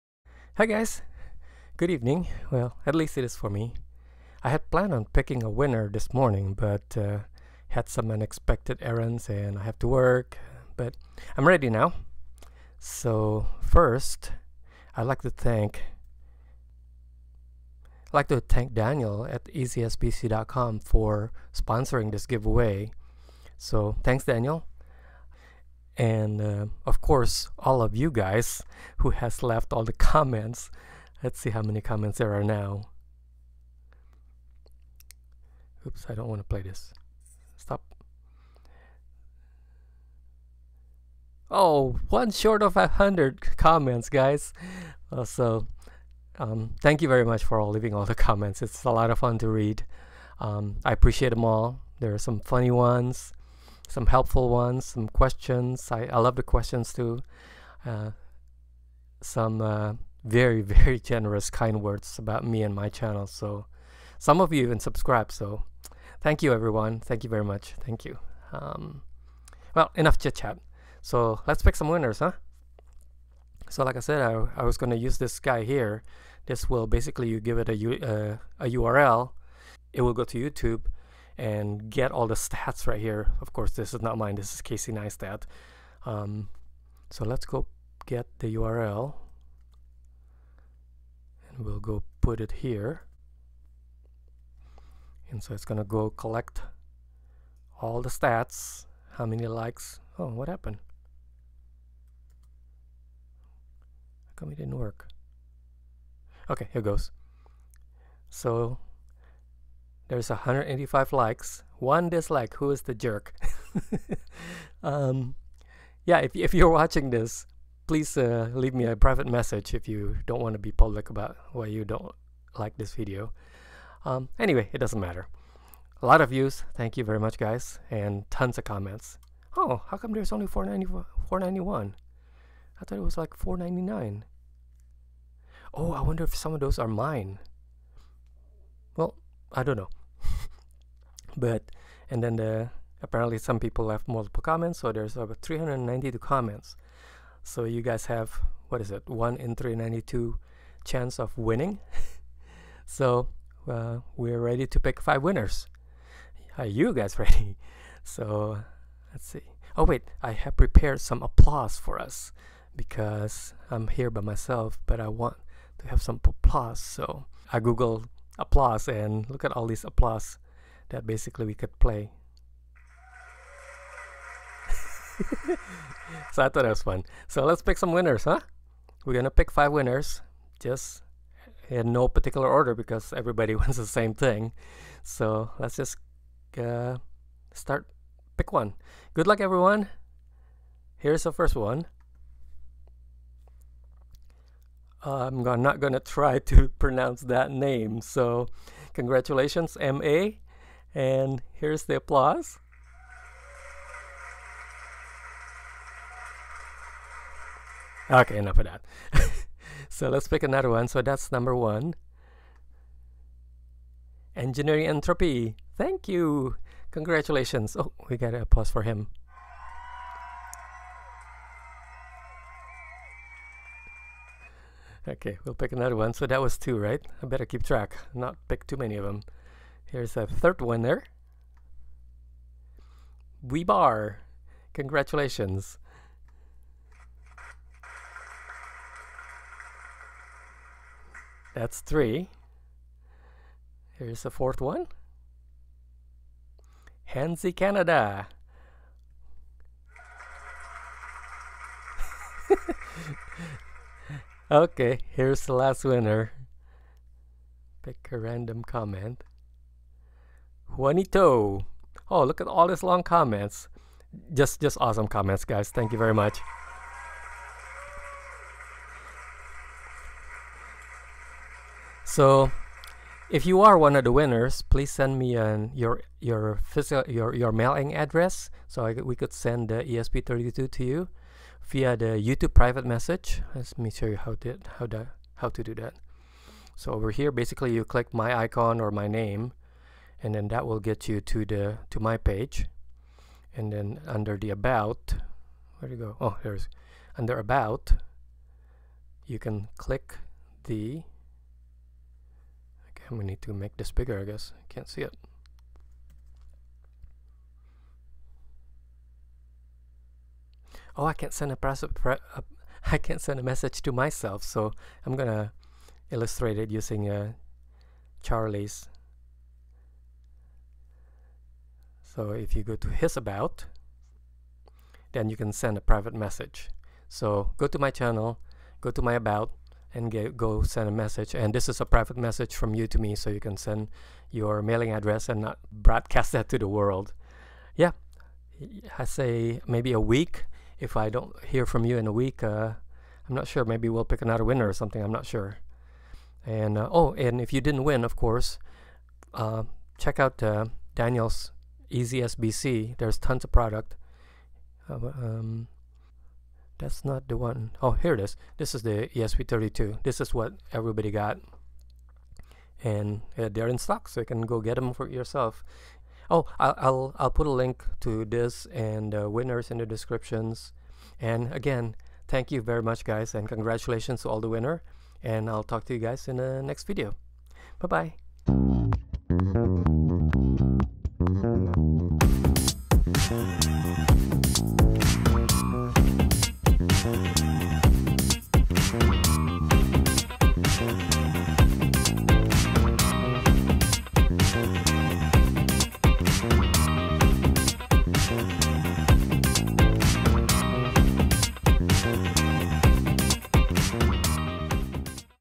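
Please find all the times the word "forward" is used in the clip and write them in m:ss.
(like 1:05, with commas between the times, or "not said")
not said.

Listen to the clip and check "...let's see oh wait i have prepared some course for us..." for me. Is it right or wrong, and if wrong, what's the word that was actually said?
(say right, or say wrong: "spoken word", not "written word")
wrong: "applause", not "course".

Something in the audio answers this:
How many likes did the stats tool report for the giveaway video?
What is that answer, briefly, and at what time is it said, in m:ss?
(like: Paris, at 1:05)
185, at 1:50.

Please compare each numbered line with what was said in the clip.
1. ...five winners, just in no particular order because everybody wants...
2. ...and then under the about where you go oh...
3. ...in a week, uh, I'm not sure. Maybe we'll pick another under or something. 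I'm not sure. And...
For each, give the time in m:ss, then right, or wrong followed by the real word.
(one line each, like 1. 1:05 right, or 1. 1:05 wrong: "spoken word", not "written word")
1. 2:59 right
2. 4:53 right
3. 5:41 wrong: "winner", not "under".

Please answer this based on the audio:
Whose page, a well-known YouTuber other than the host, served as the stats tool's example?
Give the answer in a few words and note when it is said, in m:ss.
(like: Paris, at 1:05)
Casey Neistat, at 1:24.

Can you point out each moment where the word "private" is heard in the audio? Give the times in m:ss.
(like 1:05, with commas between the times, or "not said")
1:58, 4:42, 5:25, 5:31.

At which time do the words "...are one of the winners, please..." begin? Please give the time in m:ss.
4:33.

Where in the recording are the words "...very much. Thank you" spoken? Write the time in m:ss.
1:07.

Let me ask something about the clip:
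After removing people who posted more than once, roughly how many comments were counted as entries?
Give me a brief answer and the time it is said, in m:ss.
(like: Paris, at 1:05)
392, at 2:25.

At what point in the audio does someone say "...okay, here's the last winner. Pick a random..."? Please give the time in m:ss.
4:14.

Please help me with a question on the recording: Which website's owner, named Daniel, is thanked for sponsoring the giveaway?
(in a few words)
ezsbc.com.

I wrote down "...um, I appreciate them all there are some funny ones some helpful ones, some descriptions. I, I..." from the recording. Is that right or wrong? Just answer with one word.
wrong.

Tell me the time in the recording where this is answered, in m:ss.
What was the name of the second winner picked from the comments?
3:34.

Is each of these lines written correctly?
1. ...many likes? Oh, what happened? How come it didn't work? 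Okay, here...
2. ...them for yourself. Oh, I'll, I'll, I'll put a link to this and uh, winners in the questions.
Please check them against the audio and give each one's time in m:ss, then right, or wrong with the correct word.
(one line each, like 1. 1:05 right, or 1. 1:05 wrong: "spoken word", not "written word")
1. 1:39 right
2. 6:04 wrong: "descriptions", not "questions".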